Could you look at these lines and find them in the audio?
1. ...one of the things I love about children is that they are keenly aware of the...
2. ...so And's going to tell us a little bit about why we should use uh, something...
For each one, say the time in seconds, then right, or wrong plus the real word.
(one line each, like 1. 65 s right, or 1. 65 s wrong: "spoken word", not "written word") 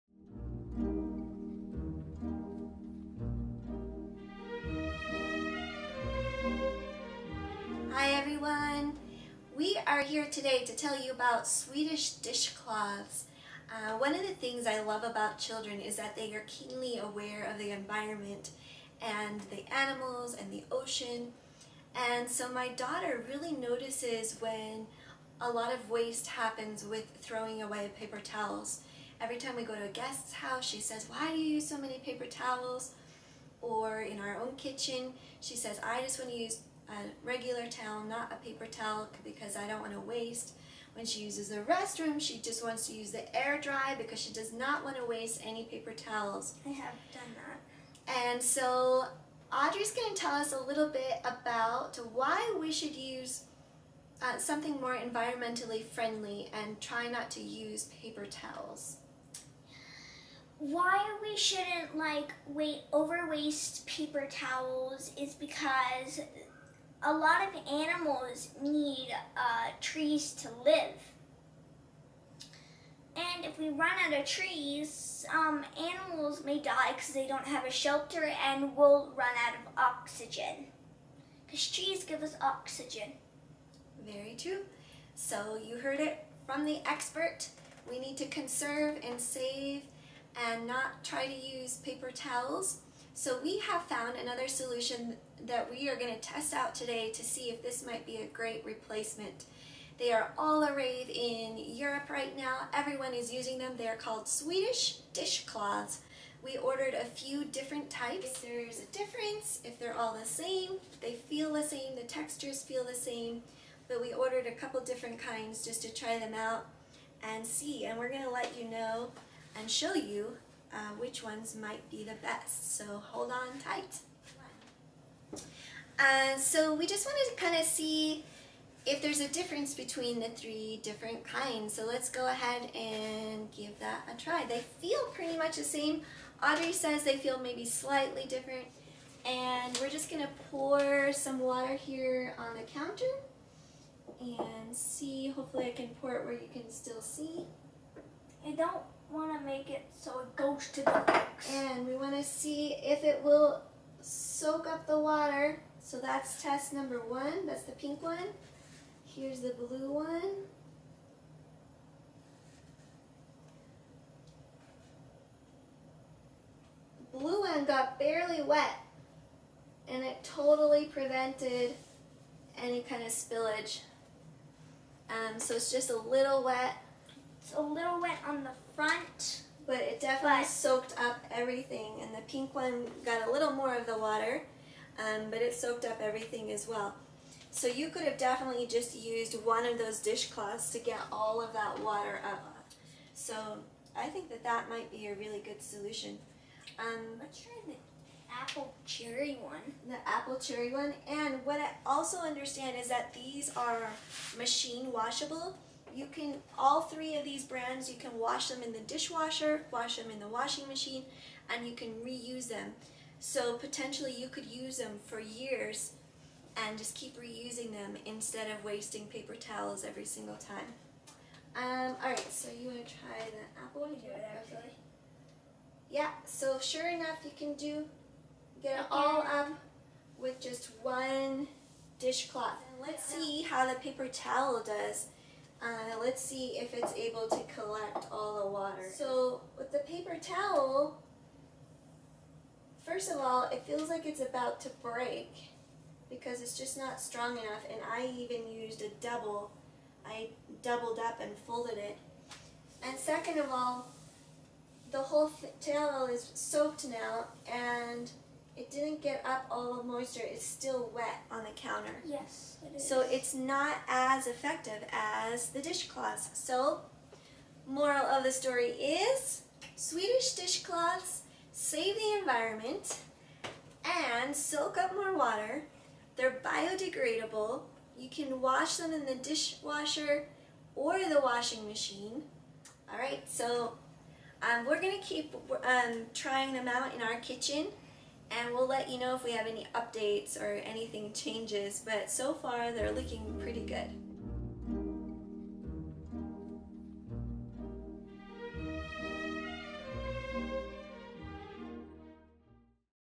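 1. 13 s right
2. 48 s wrong: "Audrey", not "And".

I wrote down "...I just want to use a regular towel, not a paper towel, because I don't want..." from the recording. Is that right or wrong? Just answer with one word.
right.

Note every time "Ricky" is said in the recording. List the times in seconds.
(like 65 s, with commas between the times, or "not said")
not said.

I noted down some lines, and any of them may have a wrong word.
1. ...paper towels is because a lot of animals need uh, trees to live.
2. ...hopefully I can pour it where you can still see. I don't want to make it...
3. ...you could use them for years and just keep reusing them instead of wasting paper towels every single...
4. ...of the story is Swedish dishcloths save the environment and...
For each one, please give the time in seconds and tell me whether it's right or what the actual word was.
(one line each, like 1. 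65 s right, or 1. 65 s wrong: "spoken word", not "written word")
1. 63 s right
2. 145 s right
3. 214 s right
4. 268 s right.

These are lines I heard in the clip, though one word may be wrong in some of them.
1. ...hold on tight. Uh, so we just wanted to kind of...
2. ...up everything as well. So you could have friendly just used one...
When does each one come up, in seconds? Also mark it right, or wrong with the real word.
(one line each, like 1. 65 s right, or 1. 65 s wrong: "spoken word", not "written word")
1. 123 s right
2. 185 s wrong: "definitely", not "friendly".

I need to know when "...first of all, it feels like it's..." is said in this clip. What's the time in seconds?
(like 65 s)
242 s.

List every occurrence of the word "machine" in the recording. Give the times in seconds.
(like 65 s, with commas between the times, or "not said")
204 s, 210 s, 281 s.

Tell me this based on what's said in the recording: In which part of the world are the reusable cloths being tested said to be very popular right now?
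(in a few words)
Europe.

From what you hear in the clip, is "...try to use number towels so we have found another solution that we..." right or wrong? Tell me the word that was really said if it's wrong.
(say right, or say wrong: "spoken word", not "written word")
wrong: "paper", not "number".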